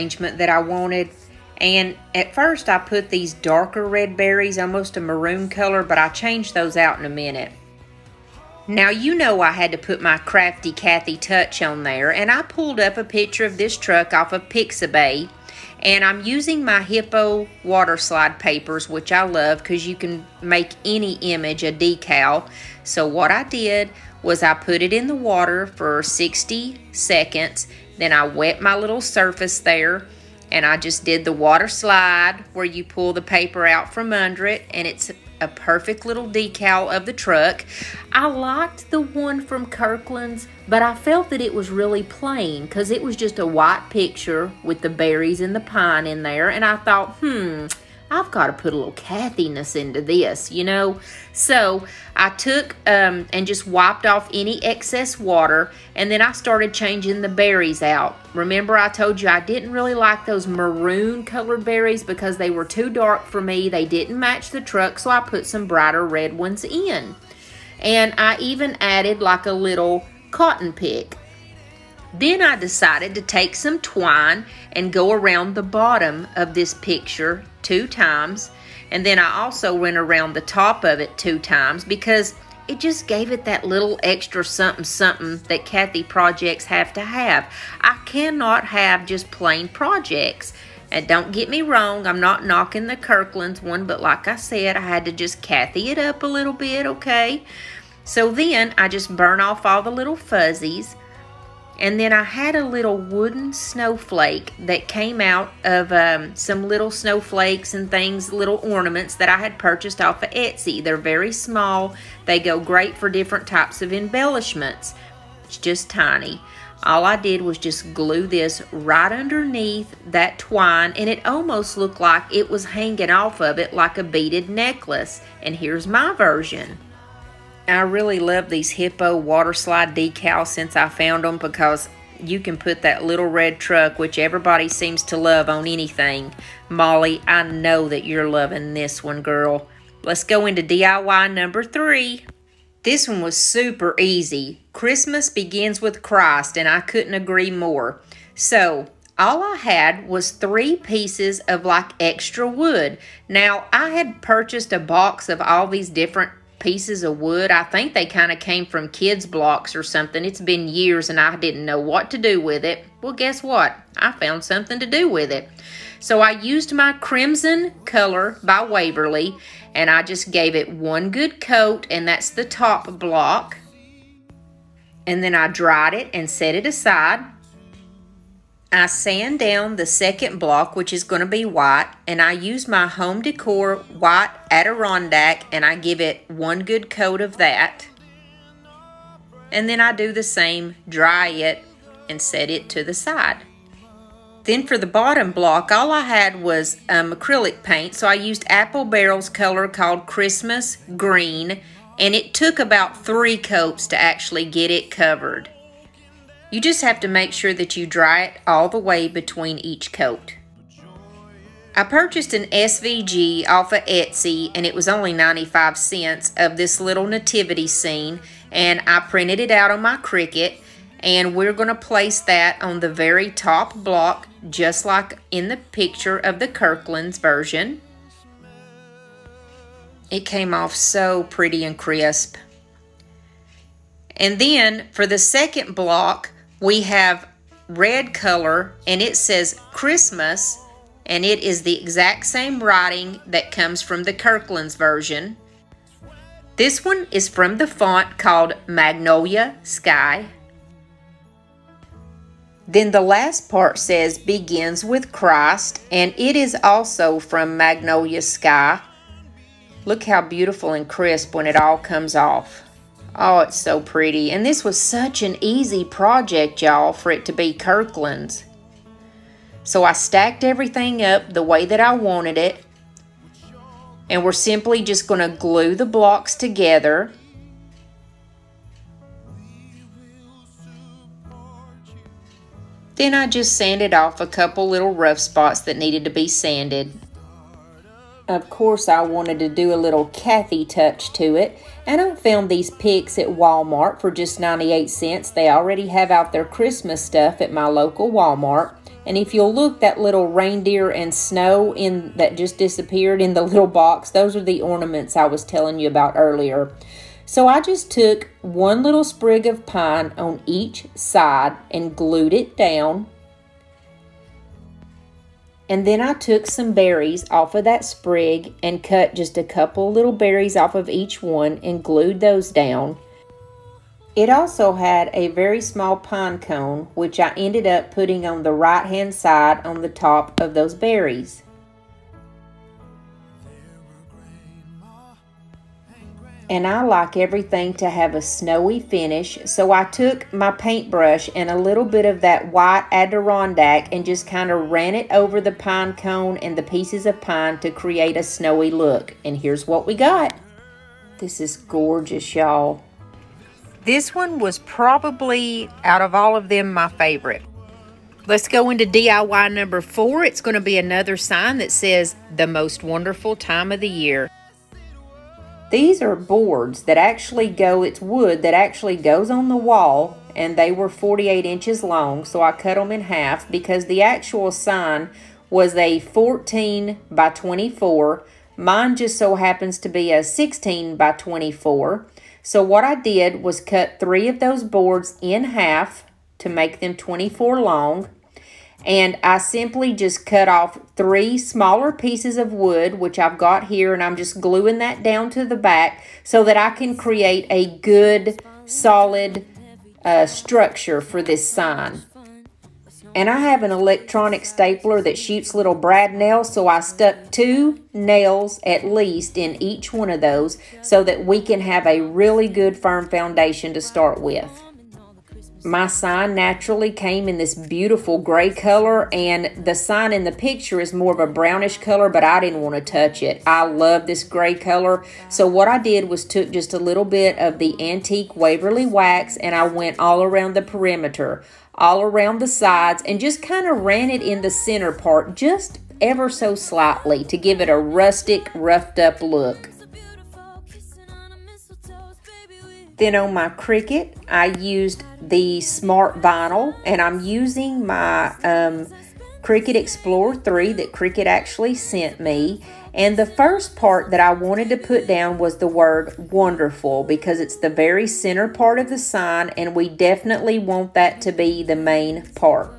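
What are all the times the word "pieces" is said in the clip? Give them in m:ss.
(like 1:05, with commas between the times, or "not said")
2:30, 2:36, 5:46, 6:31.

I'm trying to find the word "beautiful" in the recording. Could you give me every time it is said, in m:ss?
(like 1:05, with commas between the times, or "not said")
4:20, 6:57.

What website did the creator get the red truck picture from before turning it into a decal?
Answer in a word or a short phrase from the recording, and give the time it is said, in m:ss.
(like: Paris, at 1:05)
Pixabay, at 0:14.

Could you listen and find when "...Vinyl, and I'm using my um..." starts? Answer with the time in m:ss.
7:26.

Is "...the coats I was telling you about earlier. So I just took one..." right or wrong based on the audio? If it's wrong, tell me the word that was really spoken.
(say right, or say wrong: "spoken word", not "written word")
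wrong: "ornaments", not "coats".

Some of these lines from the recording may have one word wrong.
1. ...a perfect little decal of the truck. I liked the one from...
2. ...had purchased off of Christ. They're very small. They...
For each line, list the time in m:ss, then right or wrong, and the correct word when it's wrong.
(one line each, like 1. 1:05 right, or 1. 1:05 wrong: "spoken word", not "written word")
1. 0:35 right
2. 1:49 wrong: "Etsy", not "Christ".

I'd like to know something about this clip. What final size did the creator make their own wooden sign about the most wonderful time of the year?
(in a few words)
16 by 24.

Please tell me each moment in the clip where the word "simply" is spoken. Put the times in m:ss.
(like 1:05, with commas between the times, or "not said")
4:34, 6:29.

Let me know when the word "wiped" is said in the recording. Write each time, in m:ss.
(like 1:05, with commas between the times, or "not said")
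0:53.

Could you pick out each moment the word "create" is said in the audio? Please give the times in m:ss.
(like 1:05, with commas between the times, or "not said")
5:47, 6:36.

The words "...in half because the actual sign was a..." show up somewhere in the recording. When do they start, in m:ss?
6:12.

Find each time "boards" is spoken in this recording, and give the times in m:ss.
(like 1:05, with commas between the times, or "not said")
6:06, 6:24.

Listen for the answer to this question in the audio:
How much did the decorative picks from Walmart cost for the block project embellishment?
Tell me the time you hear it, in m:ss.
4:54.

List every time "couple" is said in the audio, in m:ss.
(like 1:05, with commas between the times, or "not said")
4:44, 5:19.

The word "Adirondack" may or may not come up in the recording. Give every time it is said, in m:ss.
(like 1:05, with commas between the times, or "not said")
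3:04, 5:42.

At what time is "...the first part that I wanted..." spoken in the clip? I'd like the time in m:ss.
7:33.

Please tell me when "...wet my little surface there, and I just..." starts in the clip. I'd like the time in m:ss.
0:28.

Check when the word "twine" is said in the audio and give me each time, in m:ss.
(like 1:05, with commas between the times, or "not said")
1:13, 2:00.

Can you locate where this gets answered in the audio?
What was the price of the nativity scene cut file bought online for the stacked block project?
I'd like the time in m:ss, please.
3:35.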